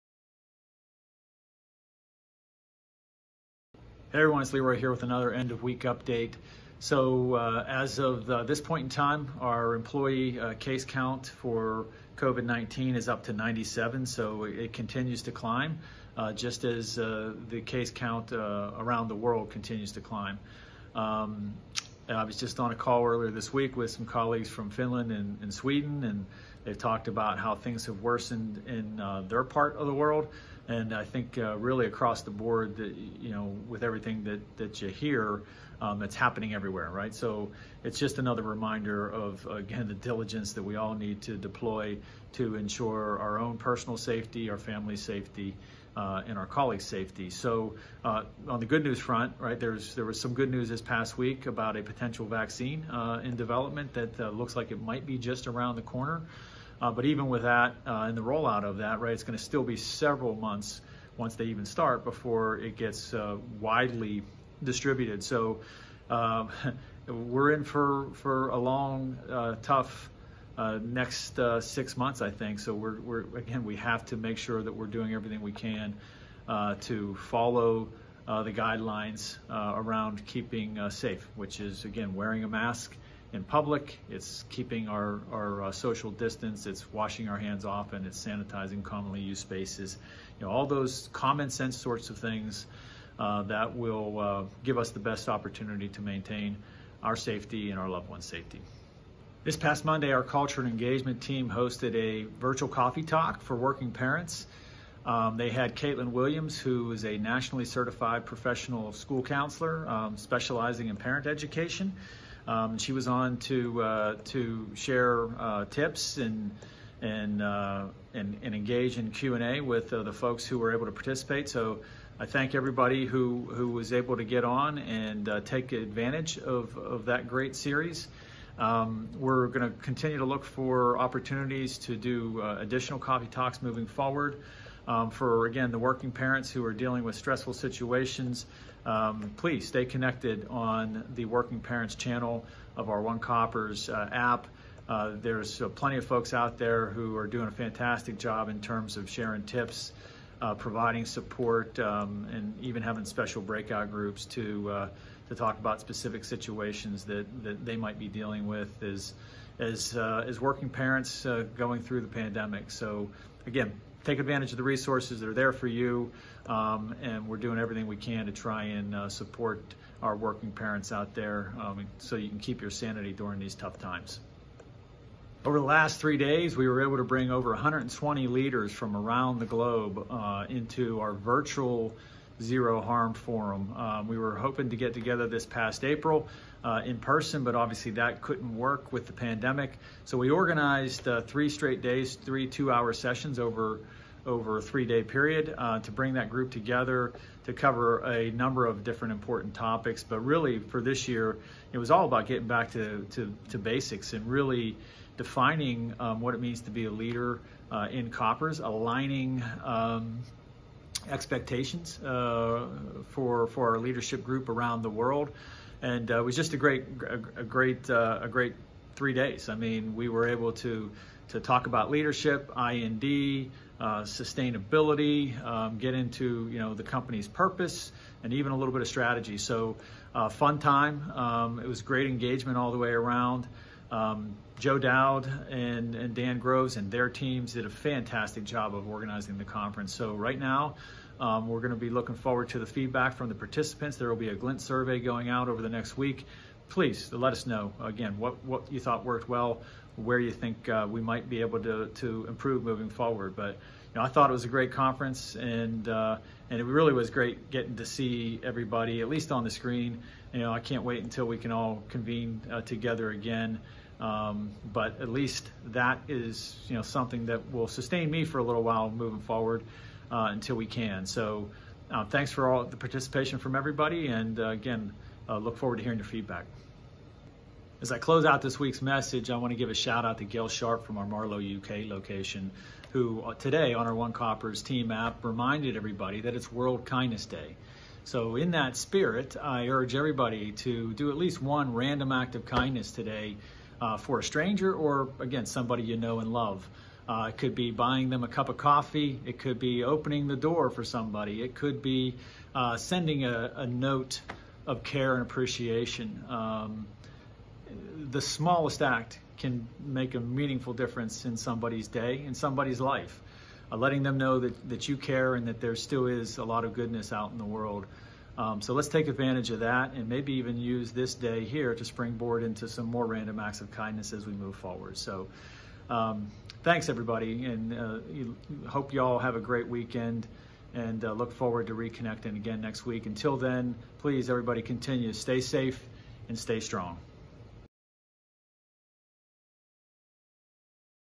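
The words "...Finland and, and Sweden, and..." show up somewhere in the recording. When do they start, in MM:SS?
00:24.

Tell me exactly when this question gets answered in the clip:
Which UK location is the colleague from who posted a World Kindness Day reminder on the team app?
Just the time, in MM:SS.
04:41.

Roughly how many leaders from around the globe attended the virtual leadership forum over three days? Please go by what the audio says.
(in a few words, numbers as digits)
Over 120.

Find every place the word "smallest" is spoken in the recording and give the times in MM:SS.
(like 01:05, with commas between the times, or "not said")
05:08.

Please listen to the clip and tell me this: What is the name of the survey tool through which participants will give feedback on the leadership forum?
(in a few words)
Glint.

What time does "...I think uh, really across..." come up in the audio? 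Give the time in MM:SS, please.
00:30.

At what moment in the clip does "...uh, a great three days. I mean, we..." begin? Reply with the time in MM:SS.
03:37.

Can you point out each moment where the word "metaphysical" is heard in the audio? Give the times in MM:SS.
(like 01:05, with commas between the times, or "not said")
not said.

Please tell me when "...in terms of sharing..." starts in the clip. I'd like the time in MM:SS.
02:28.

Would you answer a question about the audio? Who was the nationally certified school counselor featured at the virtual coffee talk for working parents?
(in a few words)
Caitlin Williams.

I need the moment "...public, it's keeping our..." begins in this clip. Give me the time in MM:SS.
01:23.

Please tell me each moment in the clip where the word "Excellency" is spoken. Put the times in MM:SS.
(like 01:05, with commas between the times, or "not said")
not said.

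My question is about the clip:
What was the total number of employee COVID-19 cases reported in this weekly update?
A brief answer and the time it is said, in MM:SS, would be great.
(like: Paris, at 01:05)
97, at 00:13.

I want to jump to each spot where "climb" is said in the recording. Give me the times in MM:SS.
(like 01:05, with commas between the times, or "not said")
00:15, 00:20.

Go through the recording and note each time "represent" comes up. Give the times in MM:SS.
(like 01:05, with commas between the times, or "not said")
not said.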